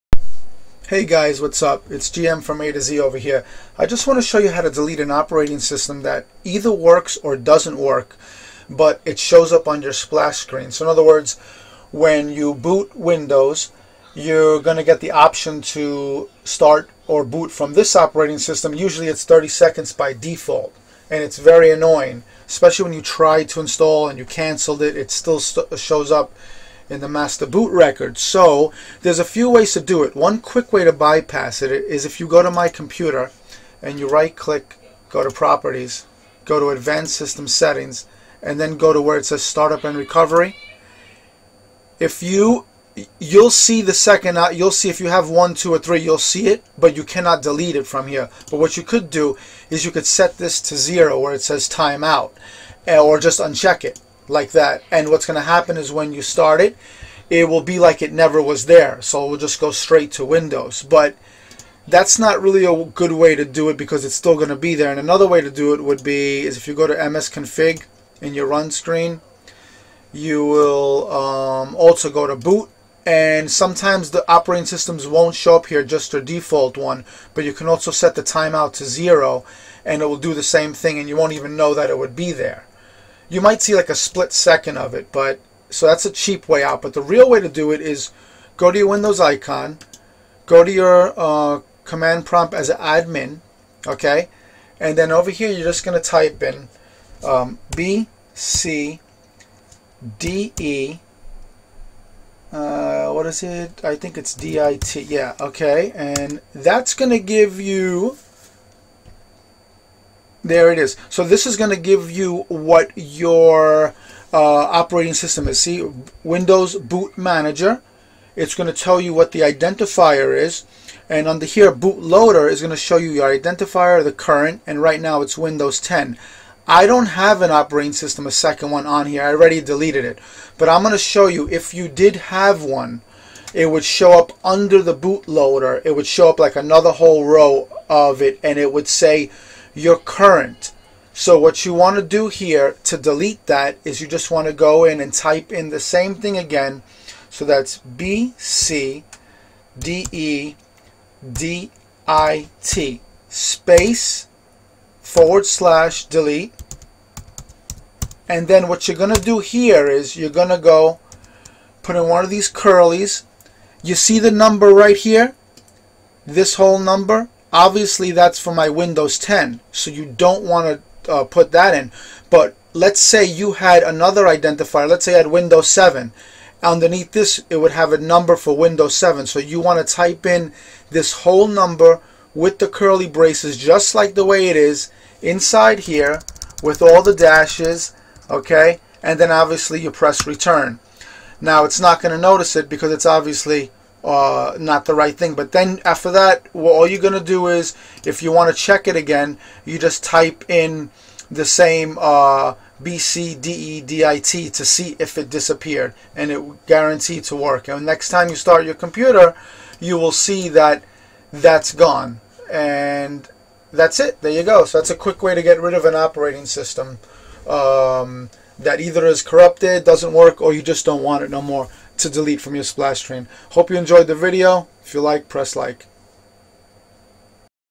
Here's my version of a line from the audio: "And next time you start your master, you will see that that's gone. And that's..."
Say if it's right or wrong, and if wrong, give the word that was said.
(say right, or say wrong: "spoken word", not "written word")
wrong: "computer", not "master".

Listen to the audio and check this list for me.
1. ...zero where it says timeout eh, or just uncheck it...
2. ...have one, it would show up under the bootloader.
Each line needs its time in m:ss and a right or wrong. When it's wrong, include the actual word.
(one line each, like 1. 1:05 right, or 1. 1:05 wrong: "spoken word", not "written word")
1. 0:50 right
2. 2:12 right.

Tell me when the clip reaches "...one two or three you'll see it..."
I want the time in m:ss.
0:45.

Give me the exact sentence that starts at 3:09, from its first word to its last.
And then obviously you press return.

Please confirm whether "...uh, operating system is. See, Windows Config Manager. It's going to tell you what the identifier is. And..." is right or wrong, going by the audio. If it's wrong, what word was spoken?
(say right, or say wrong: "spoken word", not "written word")
wrong: "Boot", not "Config".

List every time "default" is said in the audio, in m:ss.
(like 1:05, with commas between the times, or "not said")
0:20, 1:16.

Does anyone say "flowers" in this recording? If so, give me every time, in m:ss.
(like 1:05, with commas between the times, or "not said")
not said.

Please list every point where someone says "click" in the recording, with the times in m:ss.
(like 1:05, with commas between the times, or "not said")
0:34.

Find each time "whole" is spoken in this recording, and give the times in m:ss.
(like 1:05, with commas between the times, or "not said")
2:16, 2:46, 3:01.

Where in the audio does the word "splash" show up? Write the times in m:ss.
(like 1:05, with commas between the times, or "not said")
0:09, 3:42.